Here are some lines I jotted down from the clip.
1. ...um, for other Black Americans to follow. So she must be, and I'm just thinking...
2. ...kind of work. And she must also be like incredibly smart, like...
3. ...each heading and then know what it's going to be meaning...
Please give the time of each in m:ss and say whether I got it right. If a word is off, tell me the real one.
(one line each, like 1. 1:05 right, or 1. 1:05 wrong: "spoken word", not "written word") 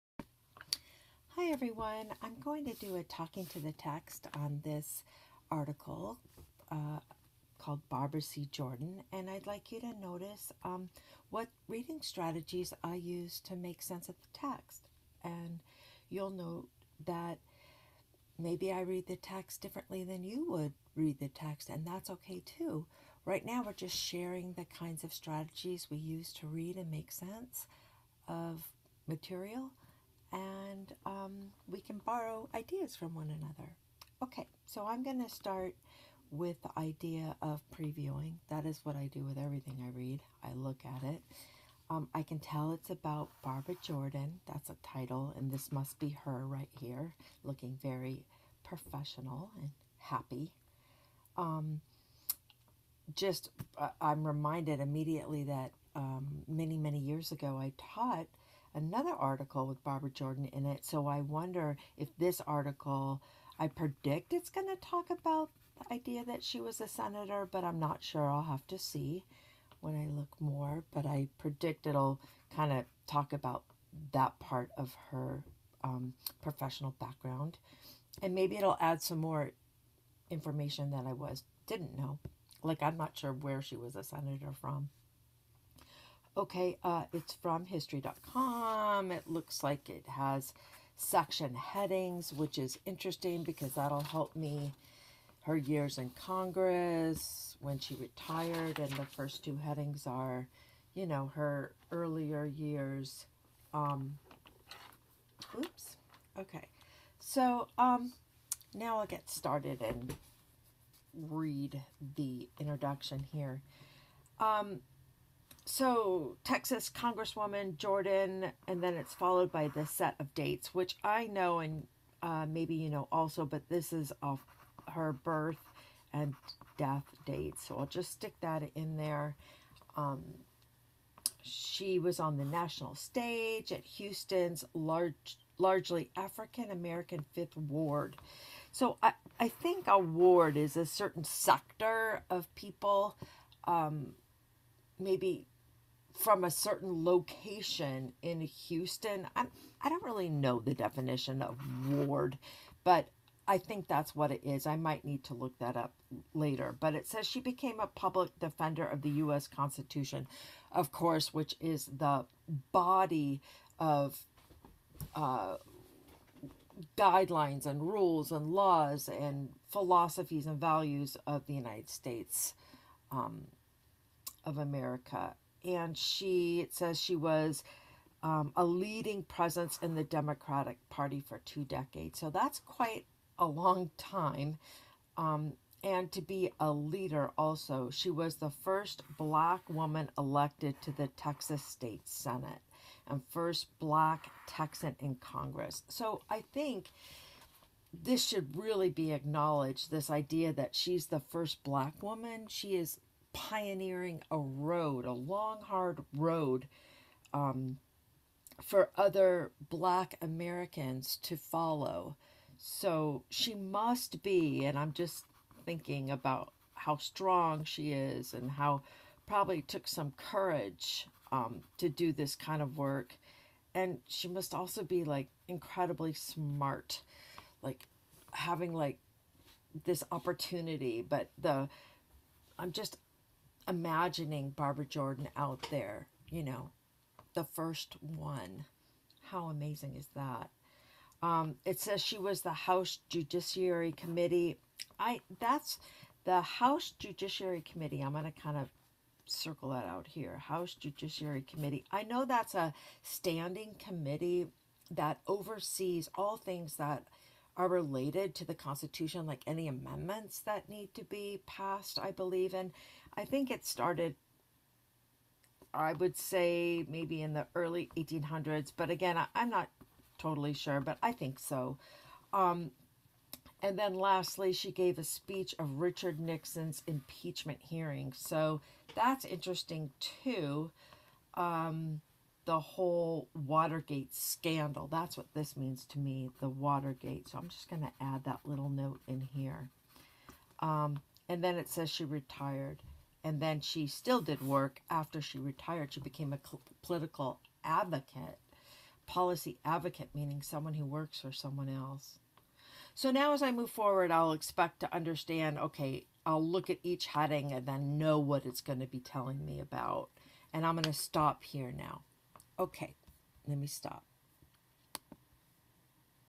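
1. 3:27 right
2. 3:42 right
3. 5:06 wrong: "telling", not "meaning".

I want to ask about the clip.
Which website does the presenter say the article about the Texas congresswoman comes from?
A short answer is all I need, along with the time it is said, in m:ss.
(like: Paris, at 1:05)
history.com, at 1:27.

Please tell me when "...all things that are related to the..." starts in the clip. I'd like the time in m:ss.
4:16.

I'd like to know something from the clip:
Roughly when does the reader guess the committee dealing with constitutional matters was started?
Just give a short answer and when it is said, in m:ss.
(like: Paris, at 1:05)
Early 1800s, at 4:27.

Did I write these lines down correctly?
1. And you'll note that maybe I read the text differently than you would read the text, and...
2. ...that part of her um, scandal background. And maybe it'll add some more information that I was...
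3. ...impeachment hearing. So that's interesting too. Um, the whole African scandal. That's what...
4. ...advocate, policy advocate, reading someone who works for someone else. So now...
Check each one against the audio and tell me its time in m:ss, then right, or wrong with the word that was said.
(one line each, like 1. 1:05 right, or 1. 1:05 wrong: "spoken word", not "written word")
1. 0:15 right
2. 1:14 wrong: "professional", not "scandal"
3. 4:36 wrong: "Watergate", not "African"
4. 4:57 wrong: "meaning", not "reading".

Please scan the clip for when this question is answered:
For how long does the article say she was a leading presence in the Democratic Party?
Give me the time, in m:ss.
3:01.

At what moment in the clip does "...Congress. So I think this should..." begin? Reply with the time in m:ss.
3:15.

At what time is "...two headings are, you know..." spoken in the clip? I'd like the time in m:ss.
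1:39.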